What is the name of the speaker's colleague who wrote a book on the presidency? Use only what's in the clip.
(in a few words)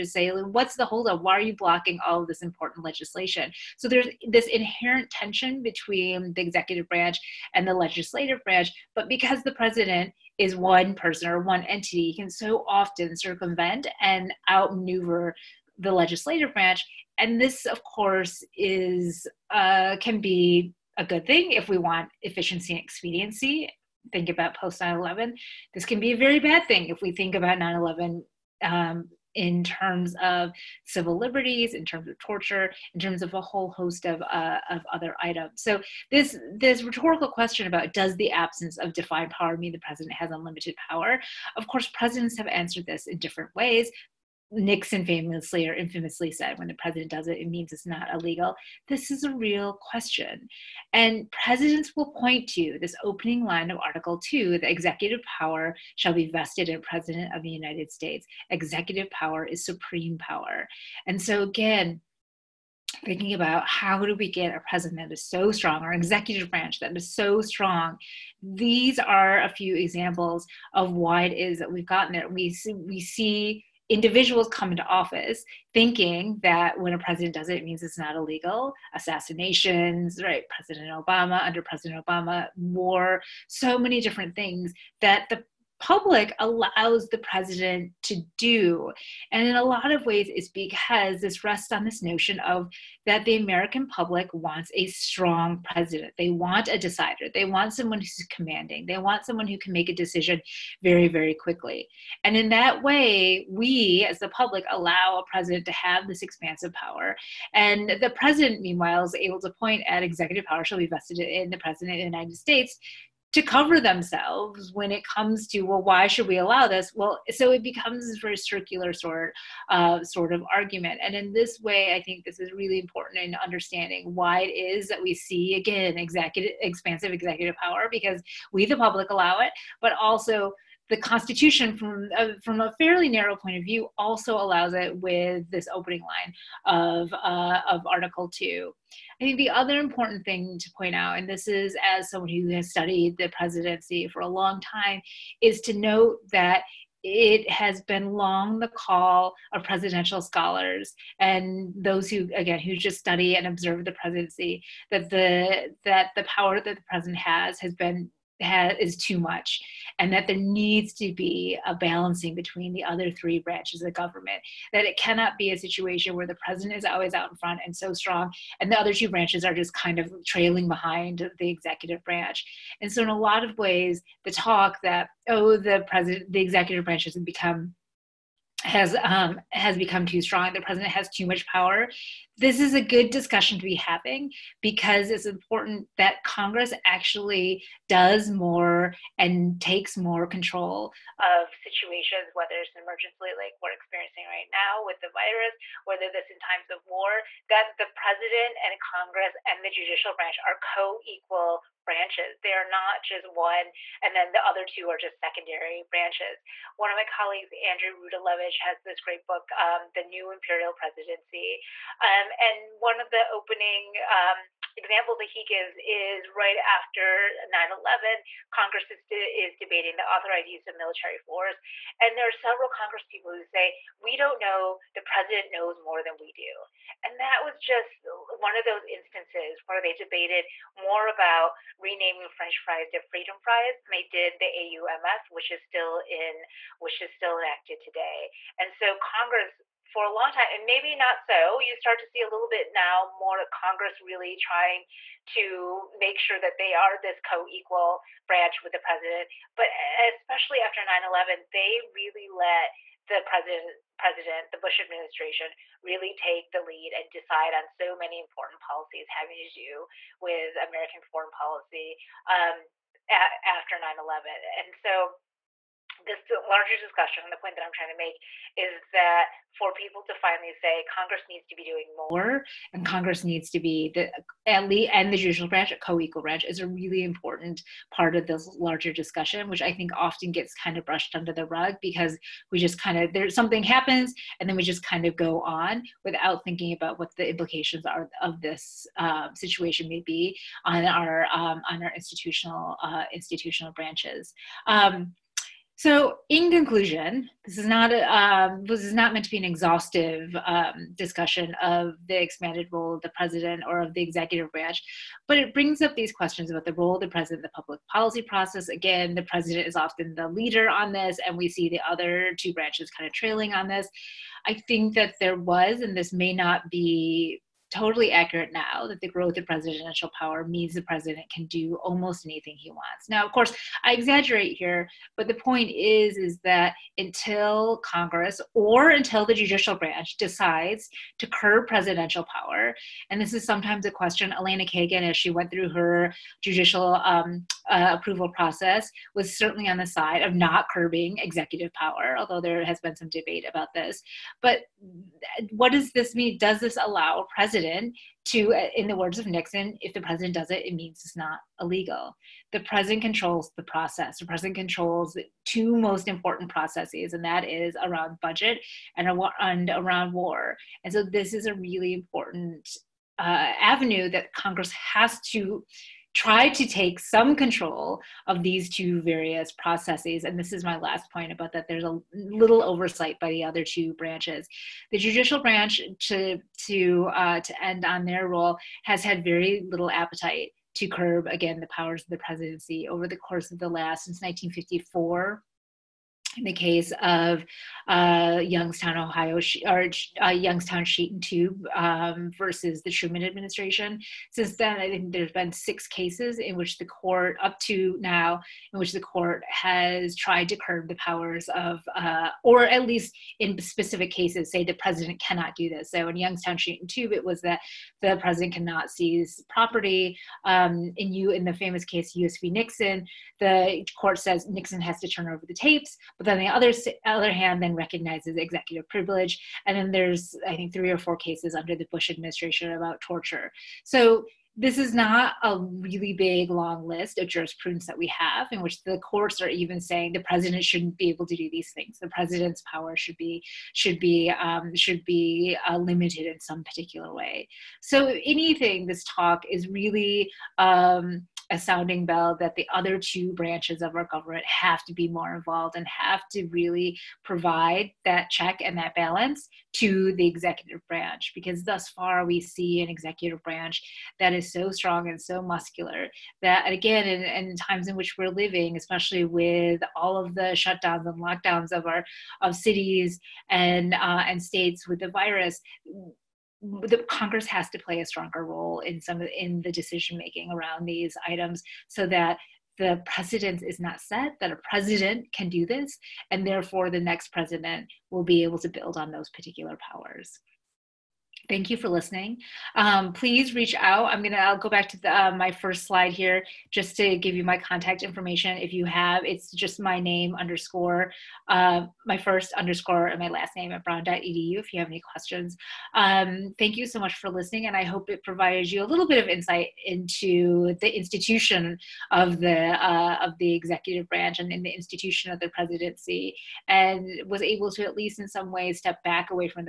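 Andrew Rudalevige.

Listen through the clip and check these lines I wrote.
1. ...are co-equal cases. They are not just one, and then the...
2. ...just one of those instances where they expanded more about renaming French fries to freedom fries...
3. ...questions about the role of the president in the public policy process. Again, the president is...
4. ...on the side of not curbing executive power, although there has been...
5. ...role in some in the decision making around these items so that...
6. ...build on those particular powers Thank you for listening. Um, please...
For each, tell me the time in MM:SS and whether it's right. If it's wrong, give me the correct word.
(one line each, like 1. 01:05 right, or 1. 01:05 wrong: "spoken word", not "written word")
1. 03:20 wrong: "branches", not "cases"
2. 03:47 wrong: "debated", not "expanded"
3. 05:06 right
4. 05:39 right
5. 07:48 right
6. 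07:58 right.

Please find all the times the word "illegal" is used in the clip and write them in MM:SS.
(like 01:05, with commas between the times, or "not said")
00:48, 01:18, 05:51.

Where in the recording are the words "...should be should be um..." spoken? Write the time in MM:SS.
07:12.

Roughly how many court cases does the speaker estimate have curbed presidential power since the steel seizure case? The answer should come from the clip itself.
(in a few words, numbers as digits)
6.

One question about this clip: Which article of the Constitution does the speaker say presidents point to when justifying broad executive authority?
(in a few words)
Article 2.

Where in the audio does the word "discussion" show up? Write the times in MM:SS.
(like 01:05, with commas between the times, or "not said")
03:03, 04:26, 04:38, 05:00.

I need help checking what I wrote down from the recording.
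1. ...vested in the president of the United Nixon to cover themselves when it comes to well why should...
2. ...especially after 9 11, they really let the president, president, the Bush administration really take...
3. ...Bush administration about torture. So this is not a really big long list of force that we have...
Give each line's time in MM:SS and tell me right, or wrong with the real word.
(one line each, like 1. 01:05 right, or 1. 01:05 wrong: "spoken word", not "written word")
1. 01:50 wrong: "States", not "Nixon"
2. 04:09 right
3. 07:01 wrong: "jurisprudence", not "force".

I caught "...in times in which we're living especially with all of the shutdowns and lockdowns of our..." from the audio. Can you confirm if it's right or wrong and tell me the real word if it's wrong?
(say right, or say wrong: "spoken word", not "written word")
right.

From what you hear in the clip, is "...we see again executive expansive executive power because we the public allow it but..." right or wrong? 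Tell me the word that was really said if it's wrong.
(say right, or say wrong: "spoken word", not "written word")
right.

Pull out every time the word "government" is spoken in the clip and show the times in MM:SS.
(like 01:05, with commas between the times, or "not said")
02:43, 07:24.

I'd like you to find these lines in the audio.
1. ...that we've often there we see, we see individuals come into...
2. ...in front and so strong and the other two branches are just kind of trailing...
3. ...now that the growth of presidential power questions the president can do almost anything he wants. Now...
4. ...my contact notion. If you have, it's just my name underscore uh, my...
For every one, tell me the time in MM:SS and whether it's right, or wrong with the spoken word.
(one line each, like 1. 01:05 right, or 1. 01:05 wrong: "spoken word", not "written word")
1. 01:11 wrong: "gotten", not "often"
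2. 02:47 right
3. 05:18 wrong: "means", not "questions"
4. 08:07 wrong: "information", not "notion".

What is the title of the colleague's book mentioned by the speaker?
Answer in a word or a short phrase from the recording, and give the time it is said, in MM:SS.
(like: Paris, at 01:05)
The New Imperial Presidency, at 03:29.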